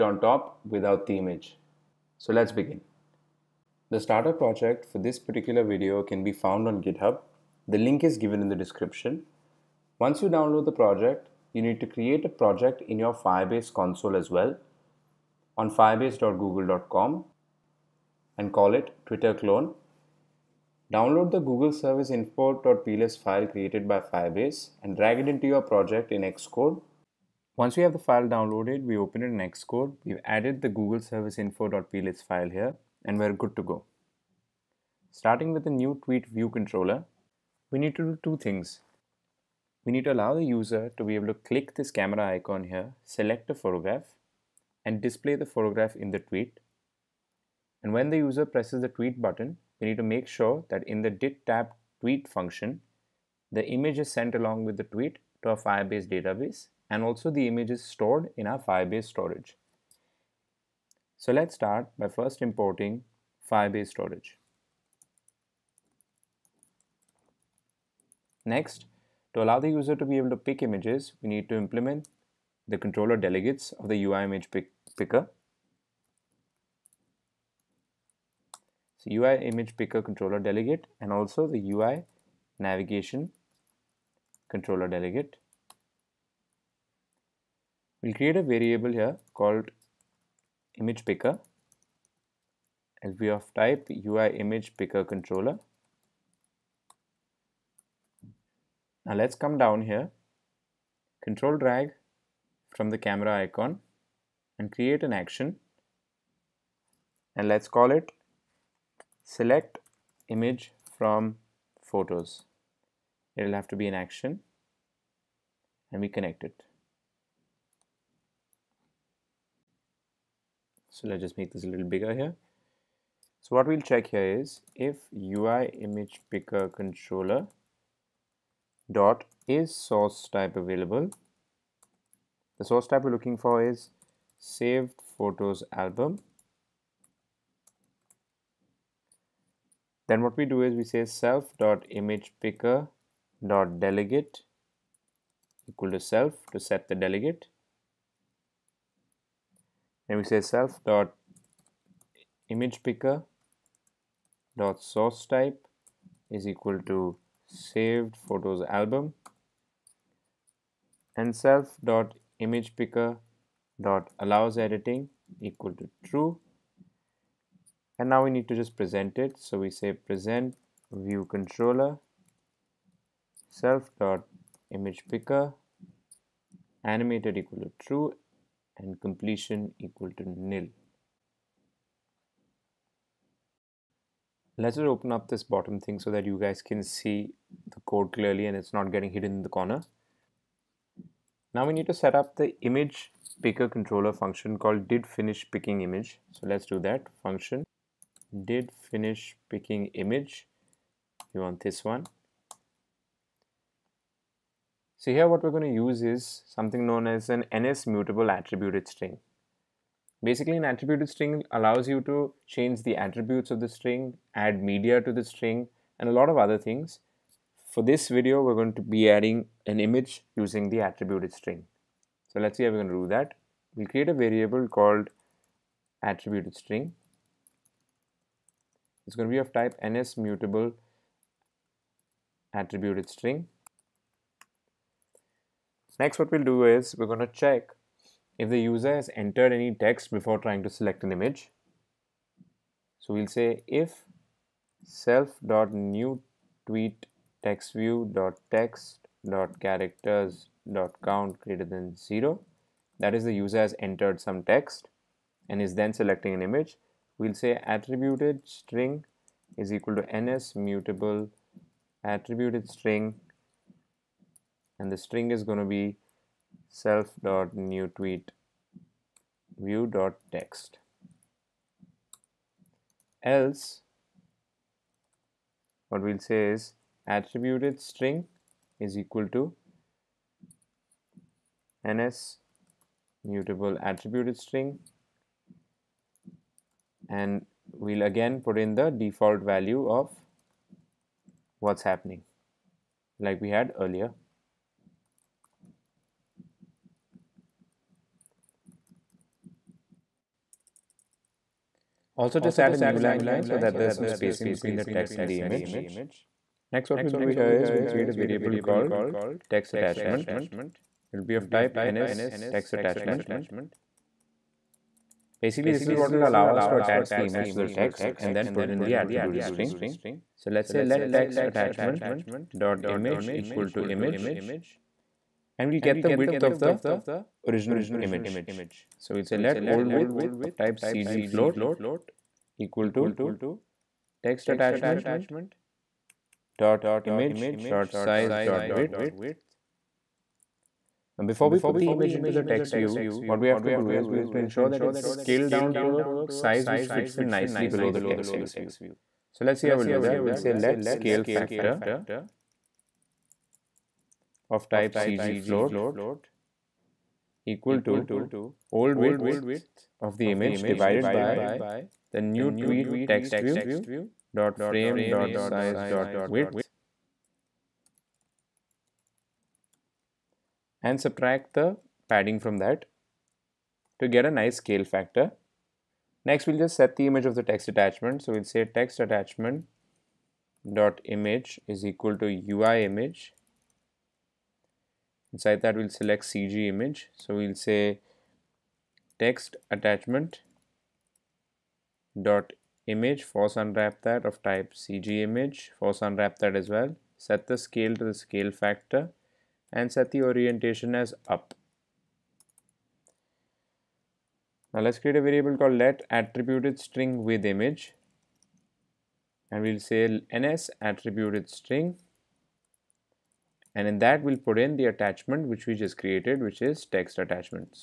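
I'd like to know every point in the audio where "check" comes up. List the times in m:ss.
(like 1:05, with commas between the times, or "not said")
2:03, 3:57.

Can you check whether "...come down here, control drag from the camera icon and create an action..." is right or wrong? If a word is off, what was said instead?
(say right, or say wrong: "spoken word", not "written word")
right.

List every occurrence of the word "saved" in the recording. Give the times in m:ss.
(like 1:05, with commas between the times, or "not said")
2:14, 2:37.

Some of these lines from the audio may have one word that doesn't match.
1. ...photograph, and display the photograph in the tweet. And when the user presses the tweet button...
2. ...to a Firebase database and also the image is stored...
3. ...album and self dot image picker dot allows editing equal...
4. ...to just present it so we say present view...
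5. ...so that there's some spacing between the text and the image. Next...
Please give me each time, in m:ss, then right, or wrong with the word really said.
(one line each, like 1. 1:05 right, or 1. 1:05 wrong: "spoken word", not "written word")
1. 0:43 right
2. 0:55 right
3. 2:38 right
4. 2:48 right
5. 5:03 right.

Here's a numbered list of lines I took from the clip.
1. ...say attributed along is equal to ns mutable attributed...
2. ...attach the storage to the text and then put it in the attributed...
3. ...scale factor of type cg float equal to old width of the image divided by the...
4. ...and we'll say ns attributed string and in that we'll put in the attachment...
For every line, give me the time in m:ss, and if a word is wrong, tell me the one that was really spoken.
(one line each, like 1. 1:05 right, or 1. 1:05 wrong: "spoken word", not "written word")
1. 4:17 wrong: "string", not "along"
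2. 5:16 wrong: "image", not "storage"
3. 5:50 right
4. 6:49 right.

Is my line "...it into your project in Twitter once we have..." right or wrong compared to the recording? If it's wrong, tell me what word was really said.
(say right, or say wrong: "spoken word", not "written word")
wrong: "Xcode", not "Twitter".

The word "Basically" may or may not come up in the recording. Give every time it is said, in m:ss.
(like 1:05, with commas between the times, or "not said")
3:30, 5:15.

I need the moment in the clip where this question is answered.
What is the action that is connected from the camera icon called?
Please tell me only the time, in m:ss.
1:49.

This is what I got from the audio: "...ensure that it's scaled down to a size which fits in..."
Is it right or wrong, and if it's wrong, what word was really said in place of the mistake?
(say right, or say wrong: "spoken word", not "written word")
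right.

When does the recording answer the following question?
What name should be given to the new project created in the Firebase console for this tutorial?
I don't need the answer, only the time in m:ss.
0:19.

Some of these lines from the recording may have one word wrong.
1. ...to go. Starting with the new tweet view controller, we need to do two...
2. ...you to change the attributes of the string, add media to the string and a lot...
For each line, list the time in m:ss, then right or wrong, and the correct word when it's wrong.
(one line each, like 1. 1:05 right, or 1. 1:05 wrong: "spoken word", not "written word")
1. 0:33 right
2. 3:31 right.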